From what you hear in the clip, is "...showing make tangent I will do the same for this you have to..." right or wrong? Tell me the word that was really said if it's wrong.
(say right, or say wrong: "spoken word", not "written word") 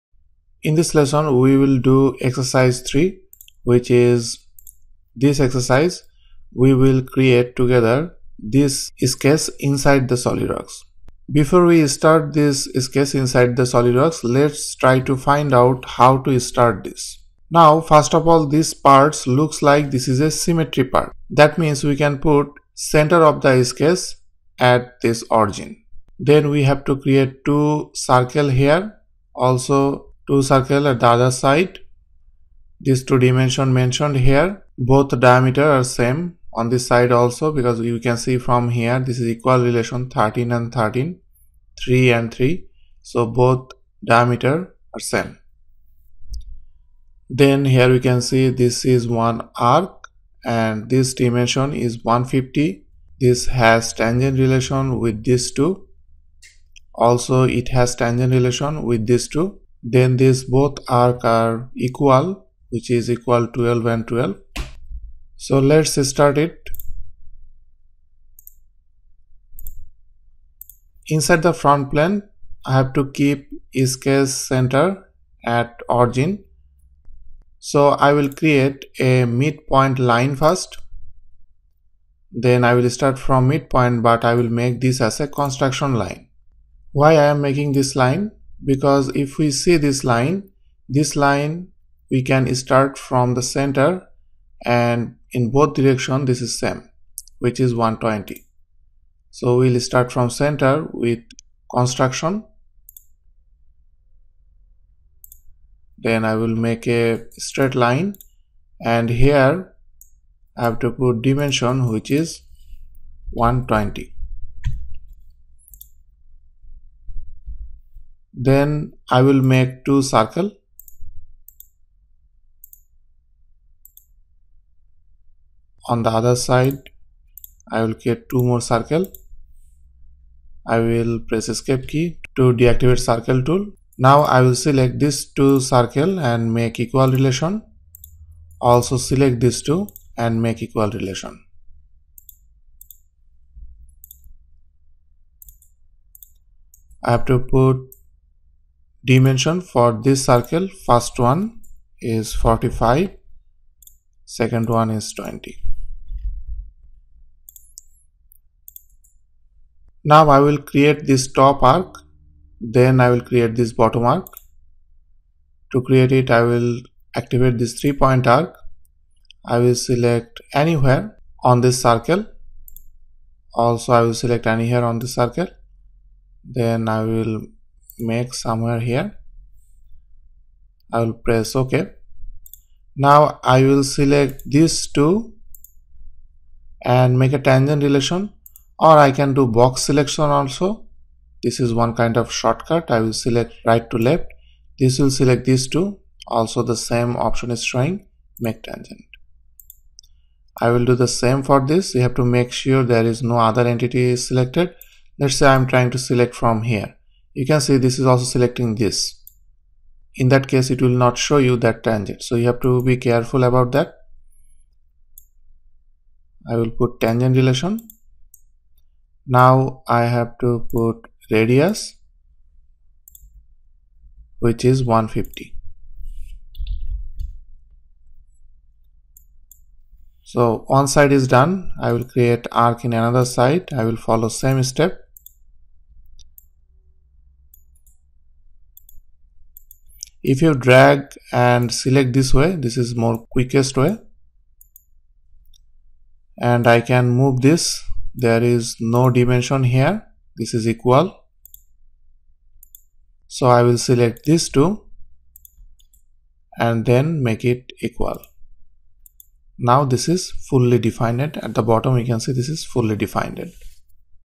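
right.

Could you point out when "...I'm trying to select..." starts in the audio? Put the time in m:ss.
3:25.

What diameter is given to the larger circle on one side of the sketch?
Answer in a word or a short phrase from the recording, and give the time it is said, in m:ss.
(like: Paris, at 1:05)
45, at 2:32.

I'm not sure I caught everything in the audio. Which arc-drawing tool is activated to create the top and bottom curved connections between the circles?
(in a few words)
three point arc.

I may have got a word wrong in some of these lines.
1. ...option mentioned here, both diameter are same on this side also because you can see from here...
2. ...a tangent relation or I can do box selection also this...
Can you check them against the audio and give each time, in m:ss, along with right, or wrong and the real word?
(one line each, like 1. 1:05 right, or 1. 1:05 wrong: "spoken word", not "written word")
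1. 0:33 wrong: "dimension", not "option"
2. 3:07 right.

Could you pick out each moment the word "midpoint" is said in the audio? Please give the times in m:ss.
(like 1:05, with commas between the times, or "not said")
1:19, 1:23.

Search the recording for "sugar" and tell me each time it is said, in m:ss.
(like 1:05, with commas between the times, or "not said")
not said.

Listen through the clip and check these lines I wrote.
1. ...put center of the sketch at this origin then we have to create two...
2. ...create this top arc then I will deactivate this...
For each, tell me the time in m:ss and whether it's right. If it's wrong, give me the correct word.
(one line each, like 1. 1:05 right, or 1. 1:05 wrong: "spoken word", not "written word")
1. 0:22 right
2. 2:40 wrong: "create", not "deactivate".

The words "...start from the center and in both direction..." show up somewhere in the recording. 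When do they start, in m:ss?
1:32.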